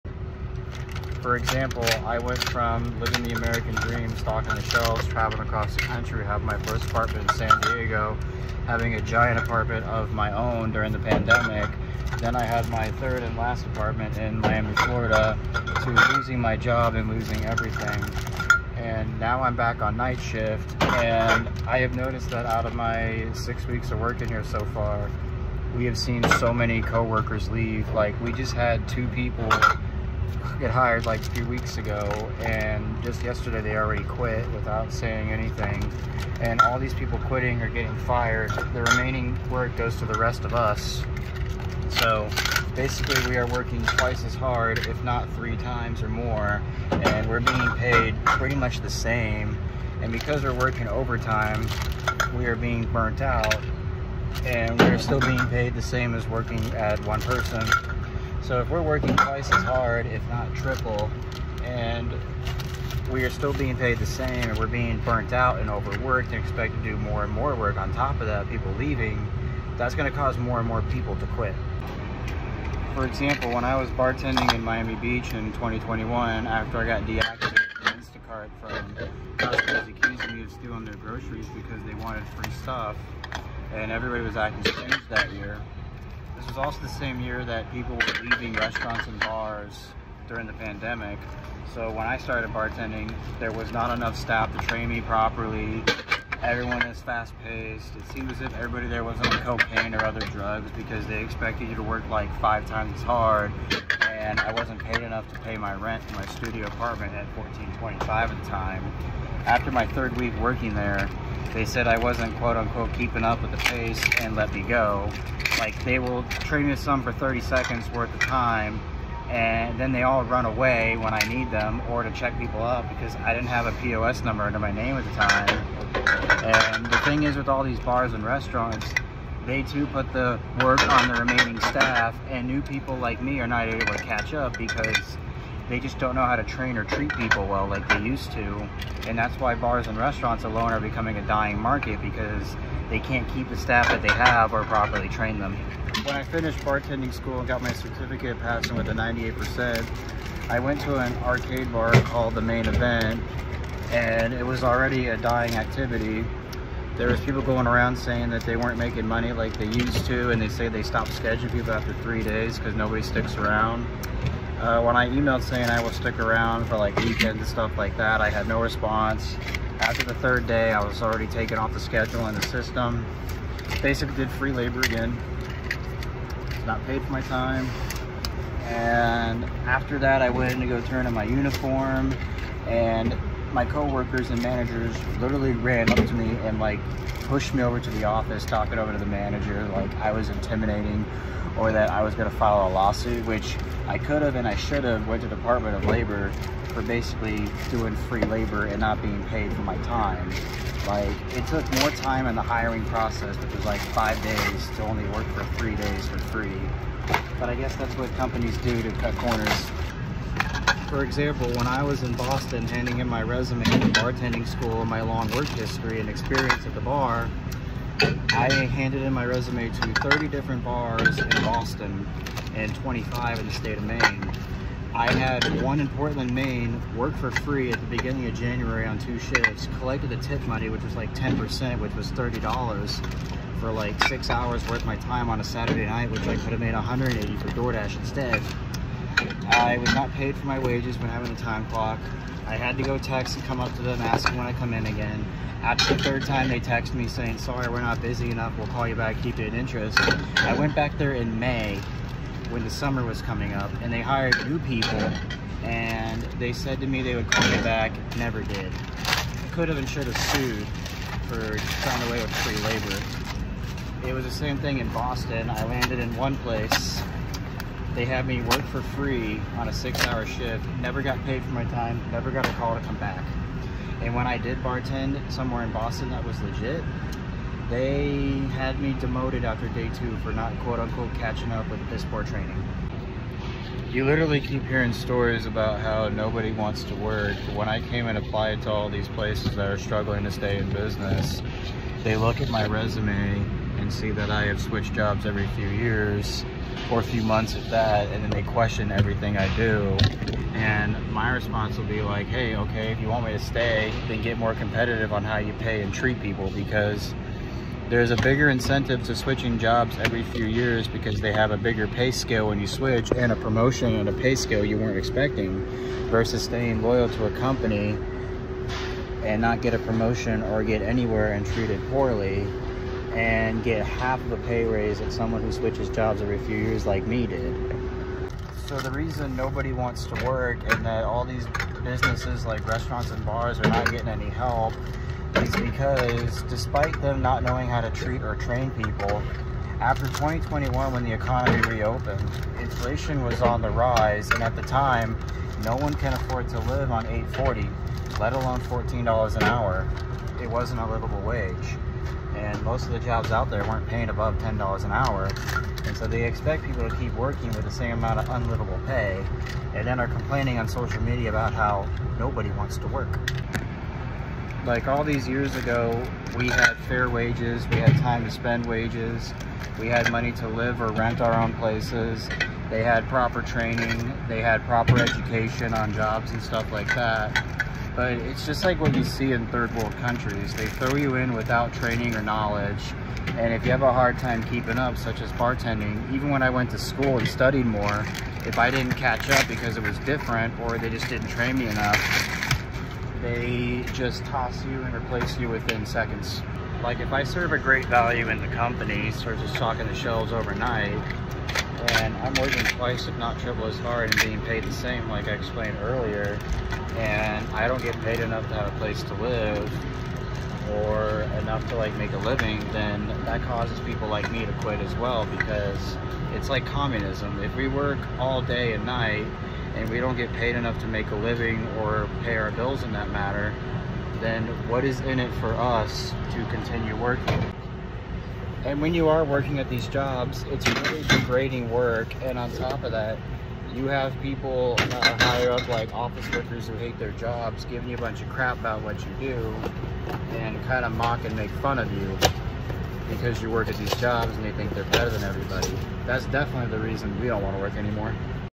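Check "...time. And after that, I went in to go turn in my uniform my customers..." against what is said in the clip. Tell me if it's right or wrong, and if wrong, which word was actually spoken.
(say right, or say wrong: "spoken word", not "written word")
wrong: "coworkers", not "customers".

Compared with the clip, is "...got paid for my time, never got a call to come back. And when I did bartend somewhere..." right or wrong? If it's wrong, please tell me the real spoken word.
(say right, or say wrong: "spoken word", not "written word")
right.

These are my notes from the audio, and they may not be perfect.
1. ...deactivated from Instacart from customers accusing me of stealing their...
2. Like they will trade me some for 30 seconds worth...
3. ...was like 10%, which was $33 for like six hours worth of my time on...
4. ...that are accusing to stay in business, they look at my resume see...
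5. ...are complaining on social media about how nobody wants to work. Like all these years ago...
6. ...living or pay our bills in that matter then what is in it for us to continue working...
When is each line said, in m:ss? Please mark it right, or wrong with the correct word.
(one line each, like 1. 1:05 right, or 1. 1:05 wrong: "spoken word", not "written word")
1. 1:17 right
2. 1:55 right
3. 3:50 wrong: "30", not "33"
4. 4:49 wrong: "struggling", not "accusing"
5. 5:59 right
6. 7:01 right.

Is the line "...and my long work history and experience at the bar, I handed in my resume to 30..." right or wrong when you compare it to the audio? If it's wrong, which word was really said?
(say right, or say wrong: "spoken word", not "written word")
right.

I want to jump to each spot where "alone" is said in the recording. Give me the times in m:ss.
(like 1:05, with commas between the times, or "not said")
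2:20, 5:48.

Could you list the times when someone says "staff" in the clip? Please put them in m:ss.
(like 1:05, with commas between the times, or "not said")
1:34, 2:11, 2:23.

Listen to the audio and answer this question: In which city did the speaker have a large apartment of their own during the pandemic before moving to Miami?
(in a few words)
San Diego.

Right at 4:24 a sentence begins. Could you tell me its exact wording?
It was the same thing in Boston.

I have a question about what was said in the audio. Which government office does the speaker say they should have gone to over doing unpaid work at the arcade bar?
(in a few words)
Department of Labor.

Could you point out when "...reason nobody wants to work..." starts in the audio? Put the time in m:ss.
5:28.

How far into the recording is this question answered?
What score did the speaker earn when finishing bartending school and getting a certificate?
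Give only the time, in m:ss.
2:28.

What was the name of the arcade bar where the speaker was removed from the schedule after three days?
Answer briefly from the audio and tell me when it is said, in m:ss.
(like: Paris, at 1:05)
The Main Event, at 2:32.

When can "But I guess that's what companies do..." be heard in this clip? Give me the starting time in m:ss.
3:27.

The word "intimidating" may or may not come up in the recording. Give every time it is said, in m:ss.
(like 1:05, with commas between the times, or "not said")
3:10.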